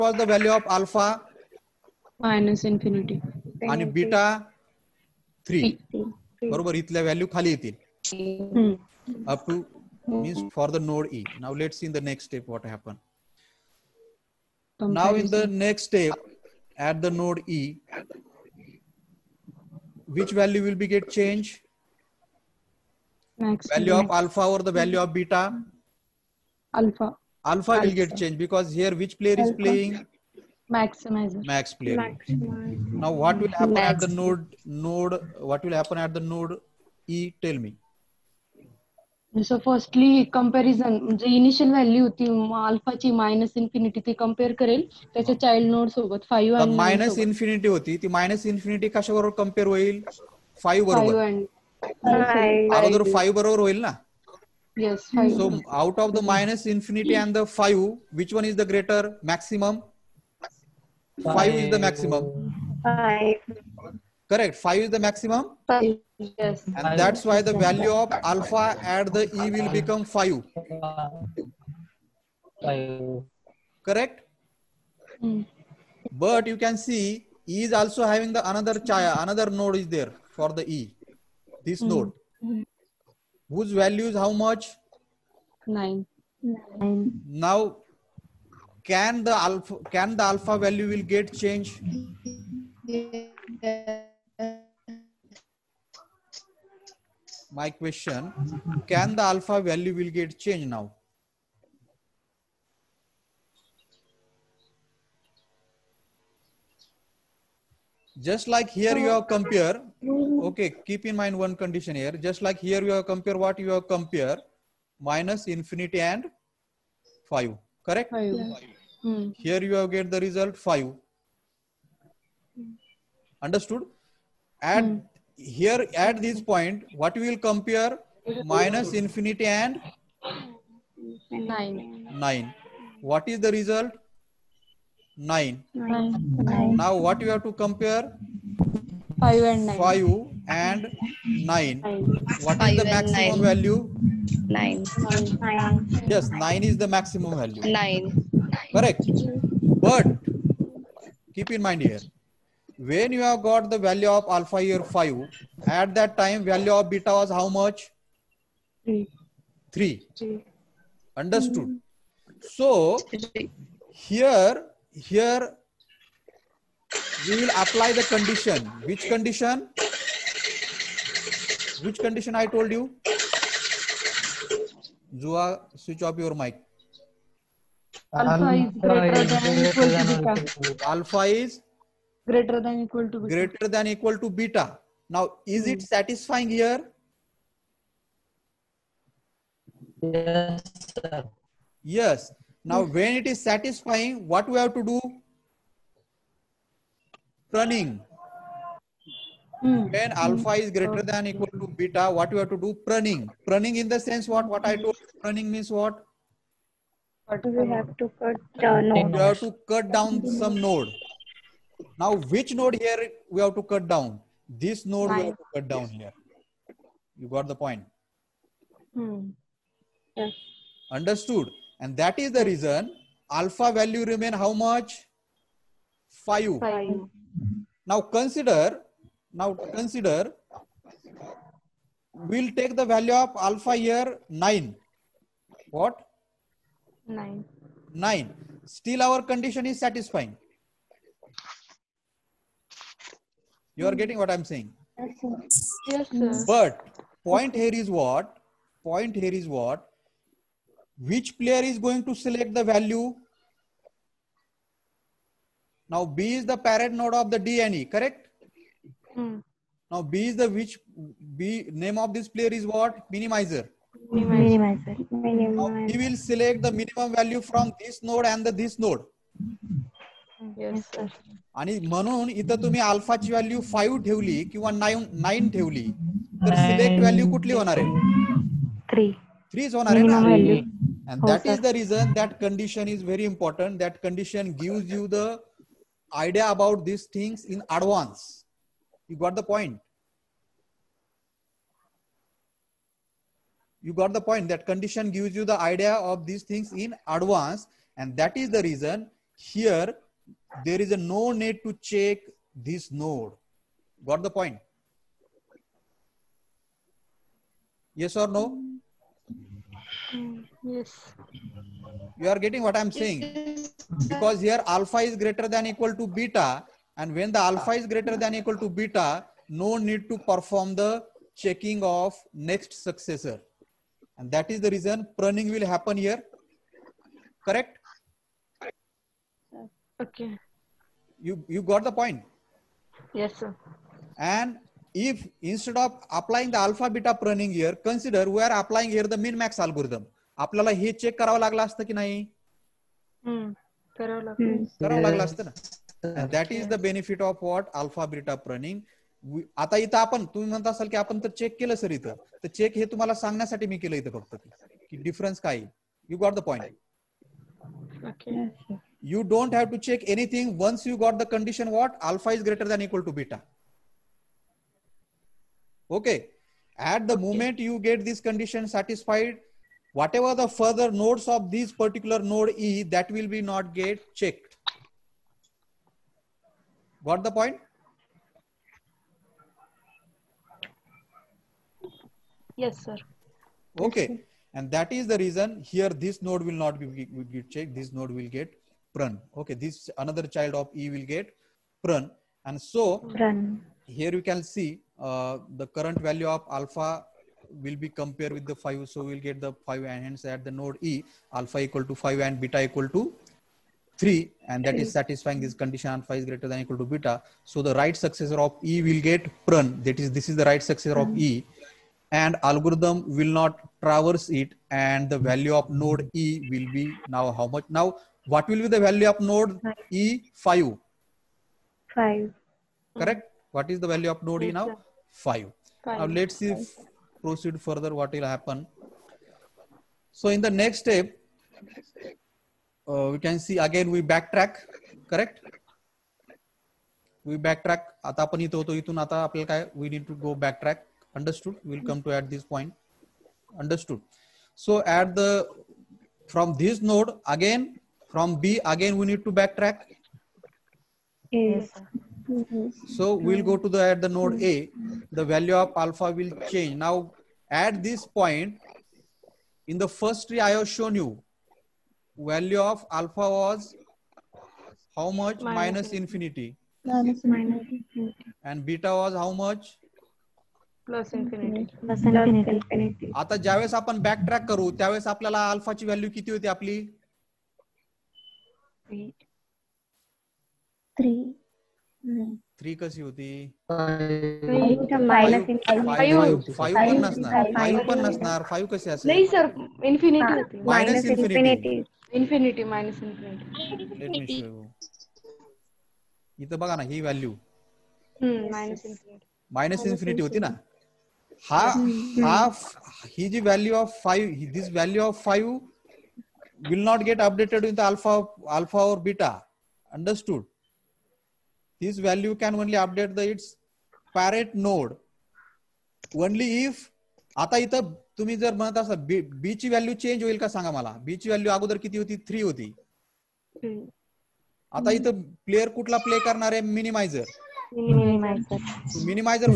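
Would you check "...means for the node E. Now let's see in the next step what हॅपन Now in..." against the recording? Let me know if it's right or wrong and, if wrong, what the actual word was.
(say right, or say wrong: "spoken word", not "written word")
right.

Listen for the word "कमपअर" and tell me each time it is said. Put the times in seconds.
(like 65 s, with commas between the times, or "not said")
44 s, 49 s.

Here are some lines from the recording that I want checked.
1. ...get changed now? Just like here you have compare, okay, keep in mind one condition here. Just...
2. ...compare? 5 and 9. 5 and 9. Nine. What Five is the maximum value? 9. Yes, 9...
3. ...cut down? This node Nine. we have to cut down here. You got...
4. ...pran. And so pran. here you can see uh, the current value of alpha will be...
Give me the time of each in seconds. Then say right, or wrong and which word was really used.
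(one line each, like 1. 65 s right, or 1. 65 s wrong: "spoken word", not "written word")
1. 100 s right
2. 137 s right
3. 213 s right
4. 391 s right.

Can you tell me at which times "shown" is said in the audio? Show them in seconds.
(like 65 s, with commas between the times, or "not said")
460 s.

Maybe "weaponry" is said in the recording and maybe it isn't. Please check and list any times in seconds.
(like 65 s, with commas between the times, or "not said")
not said.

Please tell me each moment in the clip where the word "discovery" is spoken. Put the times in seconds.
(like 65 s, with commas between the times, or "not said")
not said.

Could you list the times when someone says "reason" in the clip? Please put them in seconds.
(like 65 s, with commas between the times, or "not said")
222 s, 324 s, 385 s.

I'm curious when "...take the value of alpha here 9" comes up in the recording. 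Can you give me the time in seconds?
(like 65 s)
232 s.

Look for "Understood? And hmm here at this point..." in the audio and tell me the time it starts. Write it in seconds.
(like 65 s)
123 s.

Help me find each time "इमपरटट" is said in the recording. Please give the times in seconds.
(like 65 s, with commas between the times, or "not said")
283 s.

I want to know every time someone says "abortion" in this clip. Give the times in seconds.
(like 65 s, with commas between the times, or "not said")
not said.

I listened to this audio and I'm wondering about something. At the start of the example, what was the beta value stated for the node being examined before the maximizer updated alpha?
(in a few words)
3.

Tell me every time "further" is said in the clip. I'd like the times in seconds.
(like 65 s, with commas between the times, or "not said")
370 s, 427 s.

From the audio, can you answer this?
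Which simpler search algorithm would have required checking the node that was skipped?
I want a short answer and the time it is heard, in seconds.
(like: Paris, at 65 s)
Min max algorithm, at 339 s.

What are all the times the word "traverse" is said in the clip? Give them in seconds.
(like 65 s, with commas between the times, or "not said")
413 s.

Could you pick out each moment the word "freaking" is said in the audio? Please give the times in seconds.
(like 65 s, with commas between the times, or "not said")
not said.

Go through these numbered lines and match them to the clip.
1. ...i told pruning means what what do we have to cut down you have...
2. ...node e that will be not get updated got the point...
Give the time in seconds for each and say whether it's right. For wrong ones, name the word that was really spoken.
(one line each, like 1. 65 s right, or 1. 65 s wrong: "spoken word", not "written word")
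1. 204 s right
2. 372 s wrong: "checked", not "updated".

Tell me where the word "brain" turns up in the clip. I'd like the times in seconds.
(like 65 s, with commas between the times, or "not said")
not said.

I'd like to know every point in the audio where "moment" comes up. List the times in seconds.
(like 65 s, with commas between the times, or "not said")
367 s.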